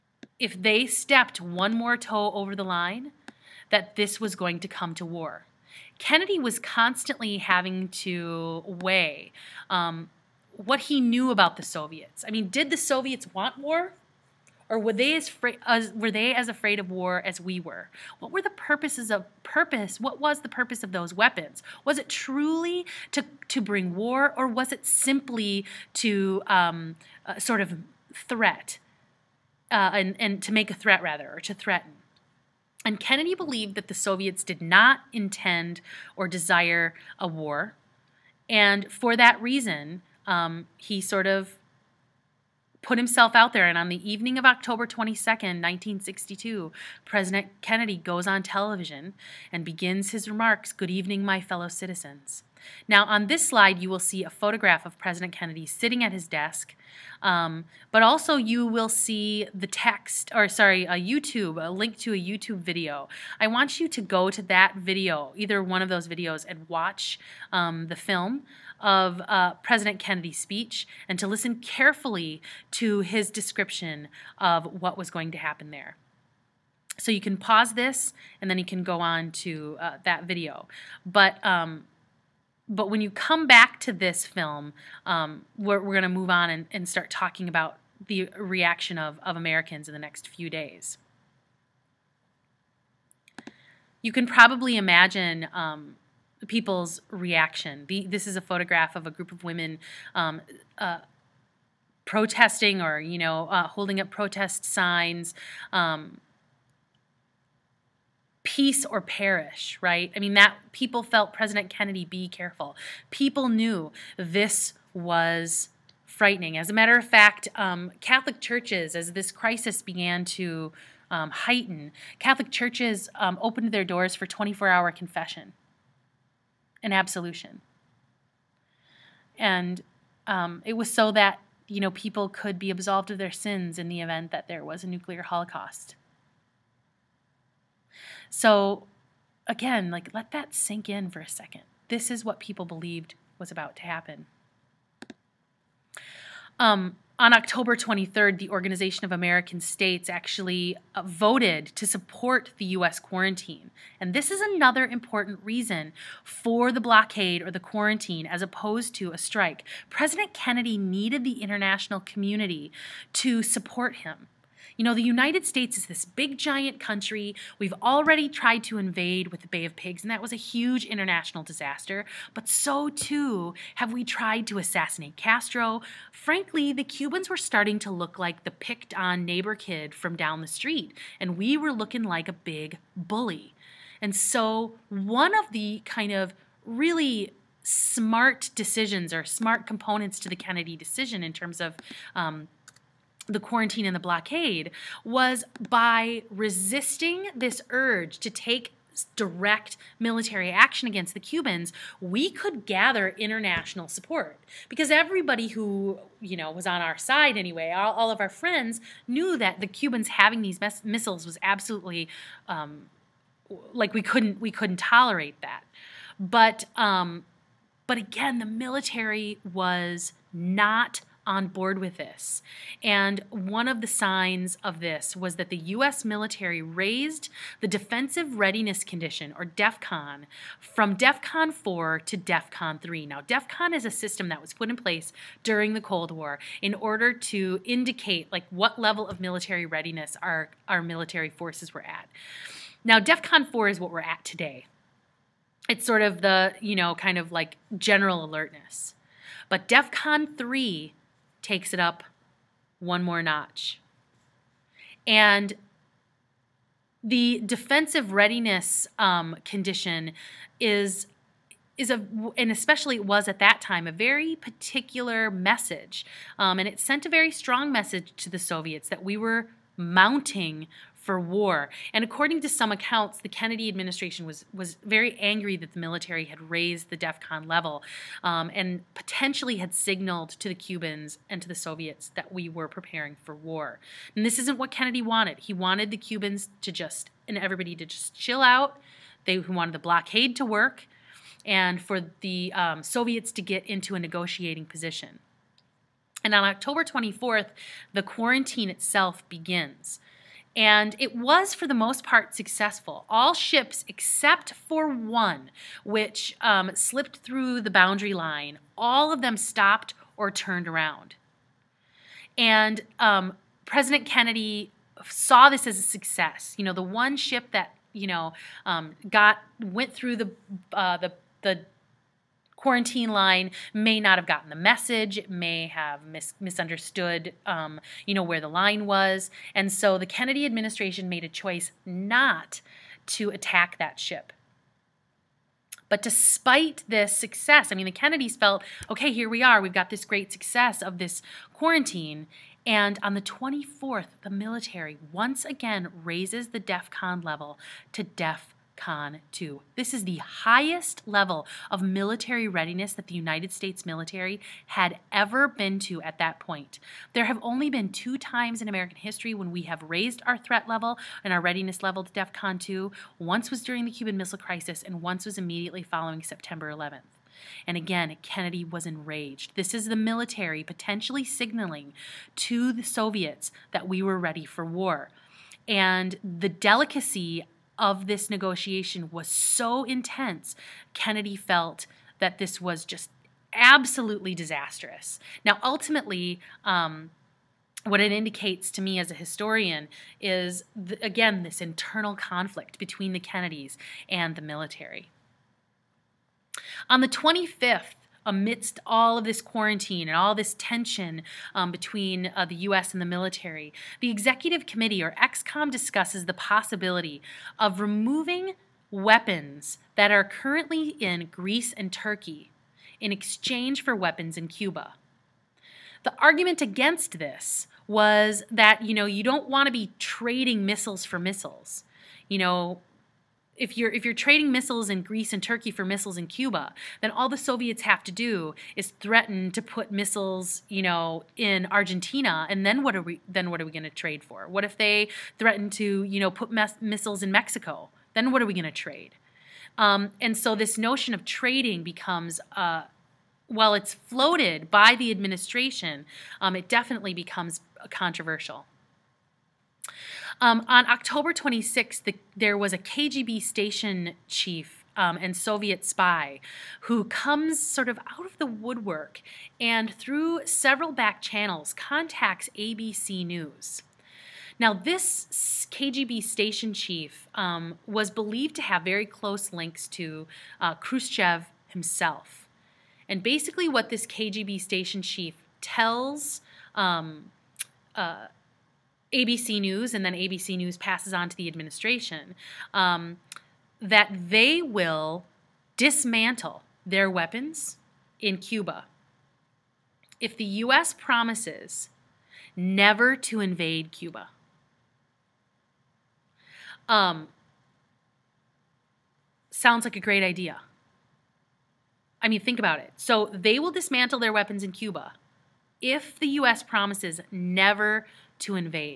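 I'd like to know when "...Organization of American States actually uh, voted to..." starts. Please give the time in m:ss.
2:28.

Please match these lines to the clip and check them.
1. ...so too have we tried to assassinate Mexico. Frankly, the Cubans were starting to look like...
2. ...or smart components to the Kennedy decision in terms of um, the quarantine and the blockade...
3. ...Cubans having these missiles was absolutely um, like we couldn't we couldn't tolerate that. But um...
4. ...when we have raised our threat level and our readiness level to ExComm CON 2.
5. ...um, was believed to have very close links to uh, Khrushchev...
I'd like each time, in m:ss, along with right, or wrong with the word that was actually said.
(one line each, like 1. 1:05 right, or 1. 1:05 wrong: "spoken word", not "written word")
1. 2:52 wrong: "Castro", not "Mexico"
2. 3:09 right
3. 3:29 right
4. 5:59 wrong: "DEF", not "ExComm"
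5. 7:47 right.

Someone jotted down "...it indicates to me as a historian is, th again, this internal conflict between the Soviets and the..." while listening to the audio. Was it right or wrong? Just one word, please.
wrong.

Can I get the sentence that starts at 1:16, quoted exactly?
So you can pause this and then you can go on to uh, that video.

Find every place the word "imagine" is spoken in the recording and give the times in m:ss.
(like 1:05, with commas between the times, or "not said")
1:34.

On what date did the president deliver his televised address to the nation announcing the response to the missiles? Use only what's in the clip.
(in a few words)
October 22nd, 1962.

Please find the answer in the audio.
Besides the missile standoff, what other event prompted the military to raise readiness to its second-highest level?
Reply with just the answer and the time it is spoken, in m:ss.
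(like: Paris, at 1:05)
September 11th, at 6:06.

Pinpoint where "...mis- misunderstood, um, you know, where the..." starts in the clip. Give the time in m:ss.
5:26.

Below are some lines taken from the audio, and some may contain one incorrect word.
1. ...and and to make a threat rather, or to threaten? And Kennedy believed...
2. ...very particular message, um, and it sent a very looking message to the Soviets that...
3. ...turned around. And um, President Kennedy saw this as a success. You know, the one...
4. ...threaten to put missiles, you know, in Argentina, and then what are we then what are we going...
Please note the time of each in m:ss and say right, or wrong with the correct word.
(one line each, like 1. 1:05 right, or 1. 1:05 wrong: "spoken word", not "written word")
1. 0:29 right
2. 4:23 wrong: "strong", not "looking"
3. 5:10 right
4. 7:08 right.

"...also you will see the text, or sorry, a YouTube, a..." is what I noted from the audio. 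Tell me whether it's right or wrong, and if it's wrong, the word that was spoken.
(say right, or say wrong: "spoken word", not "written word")
right.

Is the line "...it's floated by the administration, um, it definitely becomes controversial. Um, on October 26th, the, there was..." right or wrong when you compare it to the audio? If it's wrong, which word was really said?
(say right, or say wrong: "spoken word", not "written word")
right.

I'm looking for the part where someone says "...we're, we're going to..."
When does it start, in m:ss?
1:25.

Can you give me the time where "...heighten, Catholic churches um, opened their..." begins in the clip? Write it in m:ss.
2:01.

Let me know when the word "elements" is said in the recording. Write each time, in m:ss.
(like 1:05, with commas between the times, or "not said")
not said.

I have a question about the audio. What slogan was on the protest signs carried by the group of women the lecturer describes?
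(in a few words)
Peace or perish.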